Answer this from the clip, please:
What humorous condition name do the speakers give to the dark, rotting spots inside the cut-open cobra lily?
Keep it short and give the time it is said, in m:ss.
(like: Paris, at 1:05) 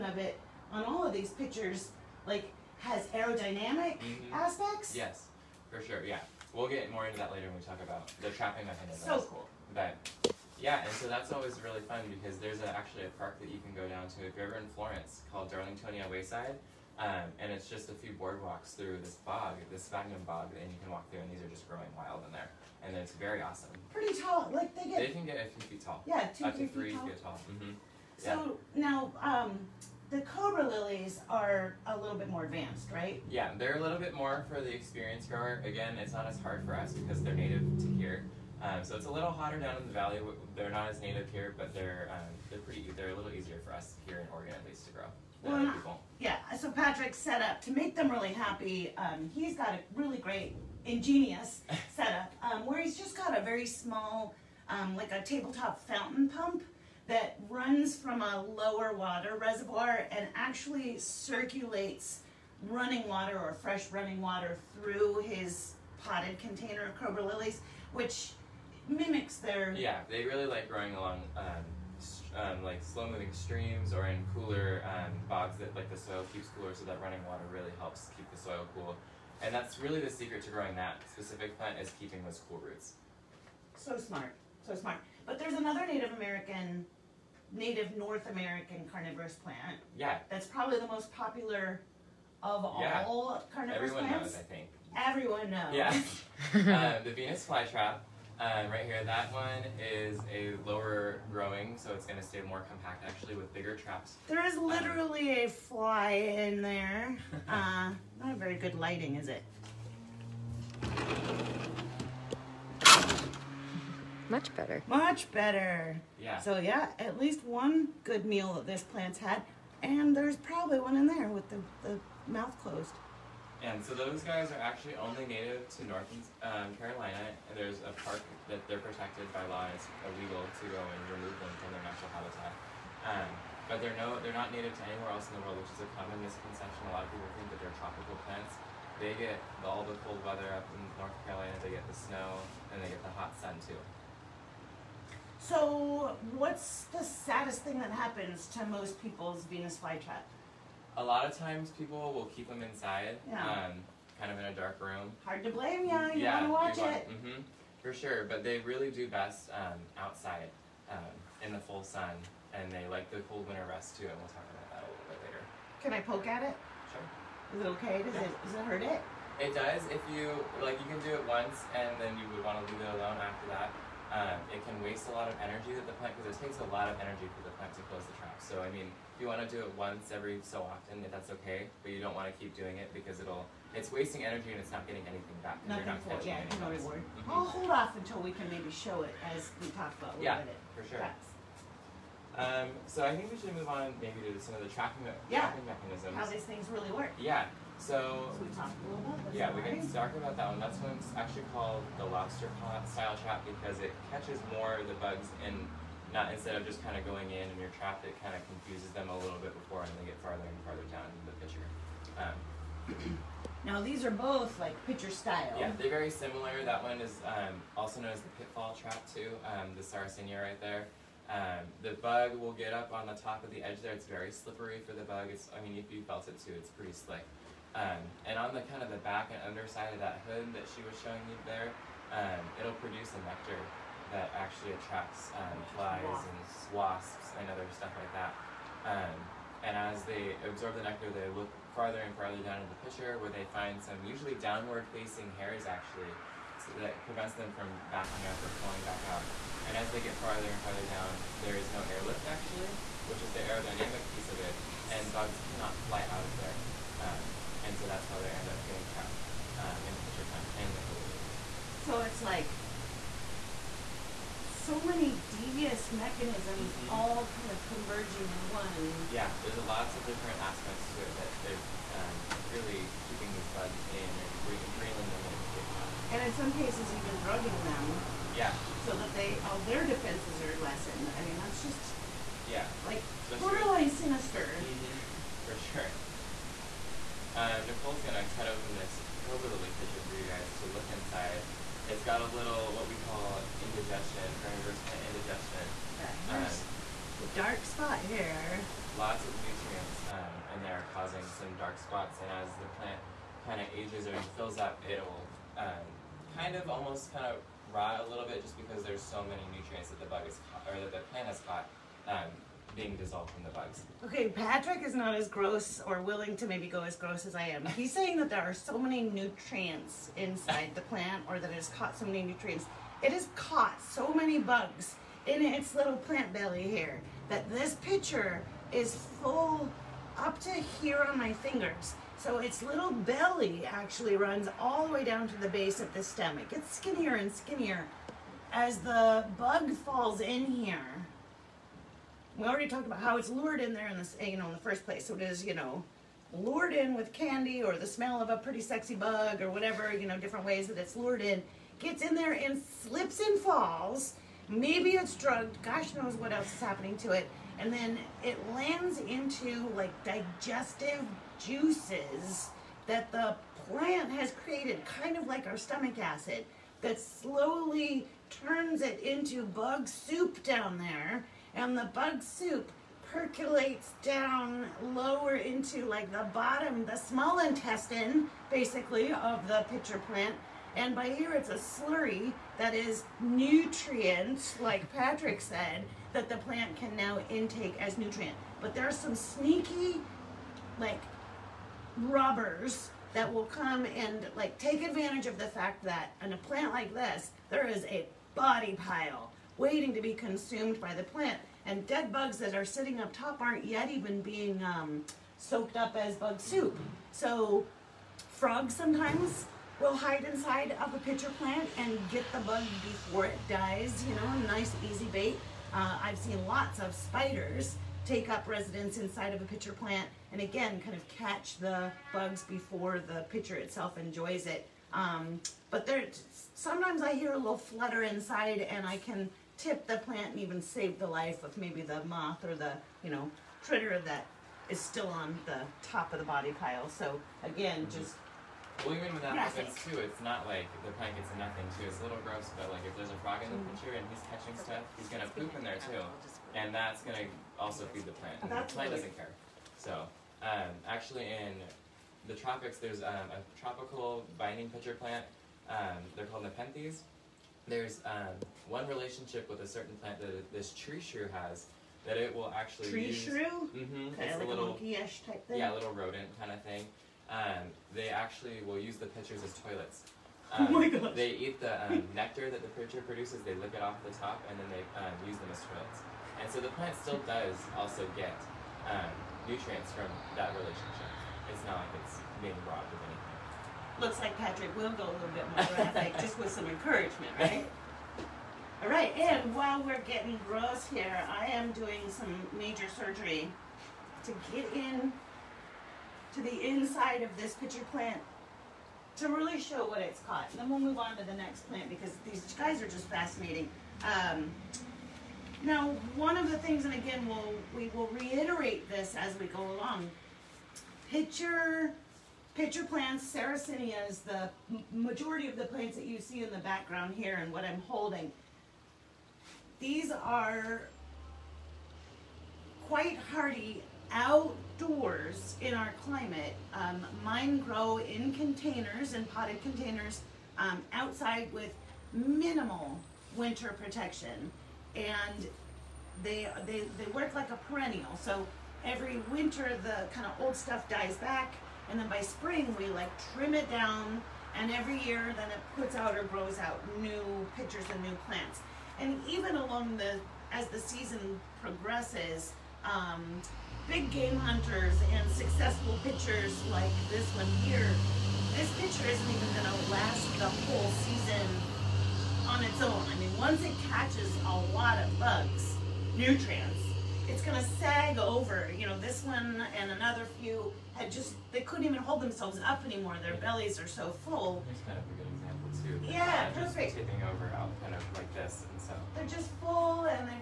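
carnivorous plant indigestion, at 4:54.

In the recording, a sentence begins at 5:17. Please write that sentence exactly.
He's saying that there are so many nutrients inside the plant or that it has caught so many nutrients.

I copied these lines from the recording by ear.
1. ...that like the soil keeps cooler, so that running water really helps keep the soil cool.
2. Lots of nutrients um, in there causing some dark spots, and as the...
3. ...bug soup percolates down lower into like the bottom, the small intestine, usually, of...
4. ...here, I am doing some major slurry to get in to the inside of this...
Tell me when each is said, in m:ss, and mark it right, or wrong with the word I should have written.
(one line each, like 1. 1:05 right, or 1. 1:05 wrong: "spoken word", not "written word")
1. 1:15 right
2. 4:58 right
3. 6:11 wrong: "basically", not "usually"
4. 8:10 wrong: "surgery", not "slurry".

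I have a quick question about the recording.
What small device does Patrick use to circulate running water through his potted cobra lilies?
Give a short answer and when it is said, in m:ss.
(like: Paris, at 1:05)
tabletop fountain pump, at 0:55.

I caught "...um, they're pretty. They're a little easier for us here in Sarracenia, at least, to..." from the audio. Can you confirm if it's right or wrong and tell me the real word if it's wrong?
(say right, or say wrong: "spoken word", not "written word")
wrong: "Oregon", not "Sarracenia".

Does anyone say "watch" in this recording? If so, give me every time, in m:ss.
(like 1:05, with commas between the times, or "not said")
2:36.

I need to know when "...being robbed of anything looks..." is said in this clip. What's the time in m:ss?
8:02.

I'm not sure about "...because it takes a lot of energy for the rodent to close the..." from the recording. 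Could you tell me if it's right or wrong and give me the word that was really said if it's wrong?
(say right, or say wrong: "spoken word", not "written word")
wrong: "plant", not "rodent".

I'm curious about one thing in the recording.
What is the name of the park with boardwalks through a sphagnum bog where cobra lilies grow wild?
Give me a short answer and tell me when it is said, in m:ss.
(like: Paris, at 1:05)
Darlingtonia Wayside, at 0:15.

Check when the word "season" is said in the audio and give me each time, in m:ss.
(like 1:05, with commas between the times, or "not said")
9:10, 9:21.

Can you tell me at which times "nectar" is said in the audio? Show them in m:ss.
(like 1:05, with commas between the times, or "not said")
3:53, 4:00, 7:52.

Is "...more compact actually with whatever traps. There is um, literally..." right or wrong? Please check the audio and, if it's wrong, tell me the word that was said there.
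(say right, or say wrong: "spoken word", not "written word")
wrong: "bigger", not "whatever".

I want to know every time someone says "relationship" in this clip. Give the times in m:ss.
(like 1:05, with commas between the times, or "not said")
7:38, 8:00.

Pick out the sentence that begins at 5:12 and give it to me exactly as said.
Um, being dissolved from the bugs.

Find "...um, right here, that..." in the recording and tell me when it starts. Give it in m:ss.
1:38.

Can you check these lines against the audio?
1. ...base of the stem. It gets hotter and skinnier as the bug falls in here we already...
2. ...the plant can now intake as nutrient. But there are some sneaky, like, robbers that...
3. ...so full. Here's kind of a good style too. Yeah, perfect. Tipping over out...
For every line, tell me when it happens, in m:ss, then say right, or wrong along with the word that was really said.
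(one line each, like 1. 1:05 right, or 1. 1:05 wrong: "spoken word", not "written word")
1. 5:35 wrong: "skinnier", not "hotter"
2. 6:26 right
3. 9:33 wrong: "example", not "style".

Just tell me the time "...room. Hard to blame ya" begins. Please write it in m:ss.
2:34.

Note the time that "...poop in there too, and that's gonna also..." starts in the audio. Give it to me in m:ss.
7:25.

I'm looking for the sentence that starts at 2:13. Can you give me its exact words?
Um, but they're no, they're not native to anywhere else in the world, which is a common misconception.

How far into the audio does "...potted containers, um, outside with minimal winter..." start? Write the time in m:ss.
8:49.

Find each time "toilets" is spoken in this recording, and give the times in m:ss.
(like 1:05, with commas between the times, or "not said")
7:49, 7:55.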